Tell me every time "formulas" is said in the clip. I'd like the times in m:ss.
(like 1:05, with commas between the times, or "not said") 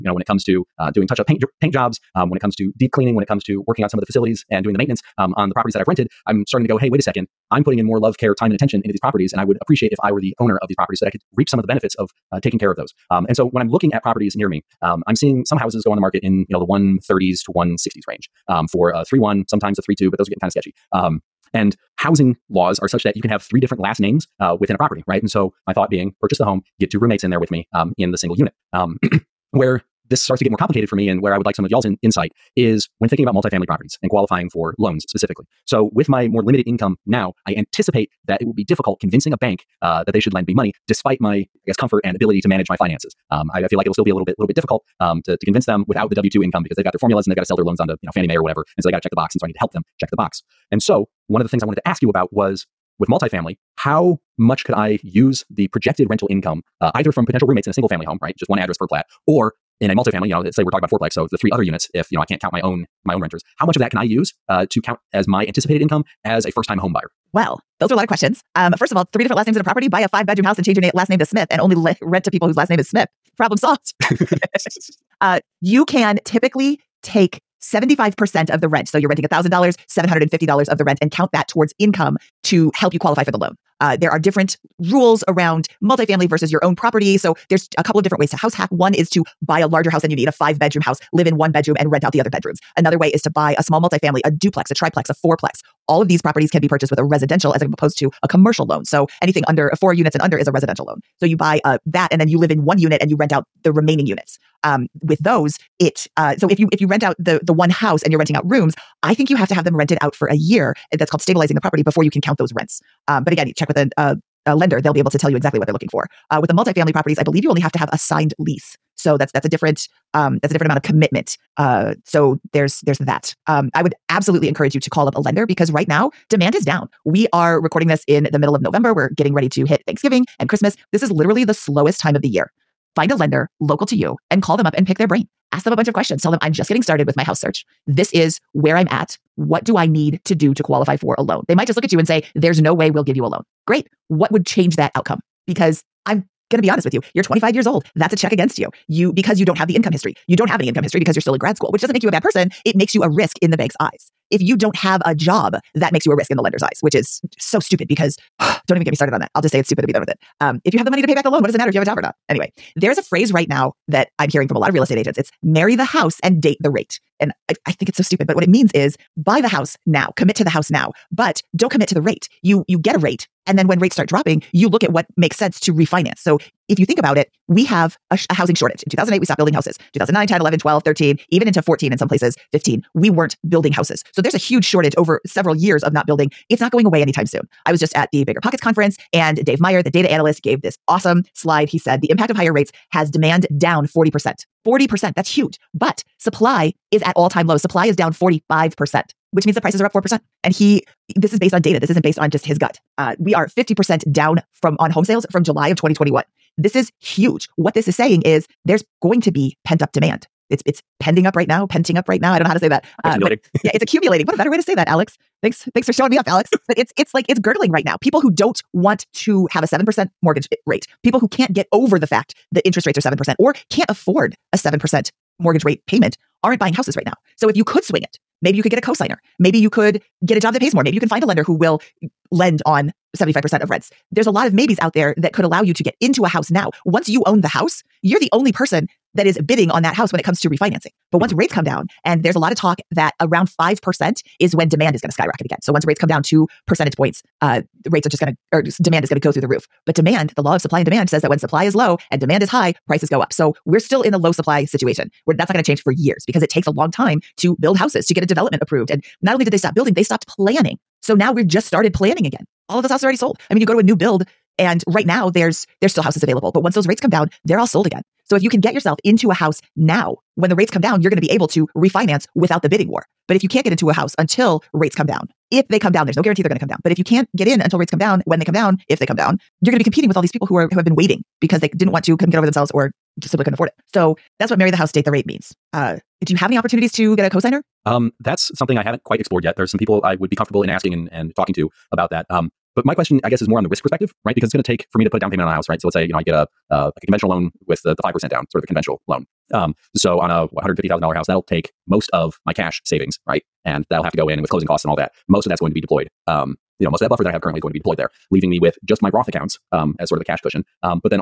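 0:46.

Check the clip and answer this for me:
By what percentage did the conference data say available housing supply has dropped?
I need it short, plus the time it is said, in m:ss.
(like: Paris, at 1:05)
45%, at 3:18.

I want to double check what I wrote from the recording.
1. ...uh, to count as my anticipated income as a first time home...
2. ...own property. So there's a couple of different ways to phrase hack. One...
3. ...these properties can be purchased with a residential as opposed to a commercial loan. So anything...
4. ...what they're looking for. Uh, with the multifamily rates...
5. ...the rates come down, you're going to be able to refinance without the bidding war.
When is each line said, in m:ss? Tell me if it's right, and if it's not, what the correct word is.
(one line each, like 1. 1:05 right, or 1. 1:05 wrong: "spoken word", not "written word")
1. 1:04 right
2. 1:26 wrong: "house", not "phrase"
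3. 1:36 right
4. 1:55 wrong: "properties", not "rates"
5. 4:30 right.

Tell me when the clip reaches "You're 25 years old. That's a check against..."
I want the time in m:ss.
2:27.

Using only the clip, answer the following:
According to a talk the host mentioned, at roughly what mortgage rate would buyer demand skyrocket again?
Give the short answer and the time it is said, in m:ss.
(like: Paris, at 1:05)
5%, at 4:03.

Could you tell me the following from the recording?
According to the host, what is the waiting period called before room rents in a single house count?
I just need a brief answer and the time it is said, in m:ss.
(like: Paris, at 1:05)
stabilizing the property, at 1:51.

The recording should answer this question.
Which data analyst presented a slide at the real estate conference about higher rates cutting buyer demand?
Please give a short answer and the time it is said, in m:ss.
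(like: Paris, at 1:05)
Dave Meyer, at 3:09.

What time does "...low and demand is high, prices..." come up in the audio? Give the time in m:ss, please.
4:11.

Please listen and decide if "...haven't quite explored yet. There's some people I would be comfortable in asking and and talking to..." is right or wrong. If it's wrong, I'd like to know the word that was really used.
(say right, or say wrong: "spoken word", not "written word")
right.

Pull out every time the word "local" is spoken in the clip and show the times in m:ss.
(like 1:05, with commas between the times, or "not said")
2:13.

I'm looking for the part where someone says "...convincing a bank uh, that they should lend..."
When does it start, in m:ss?
0:39.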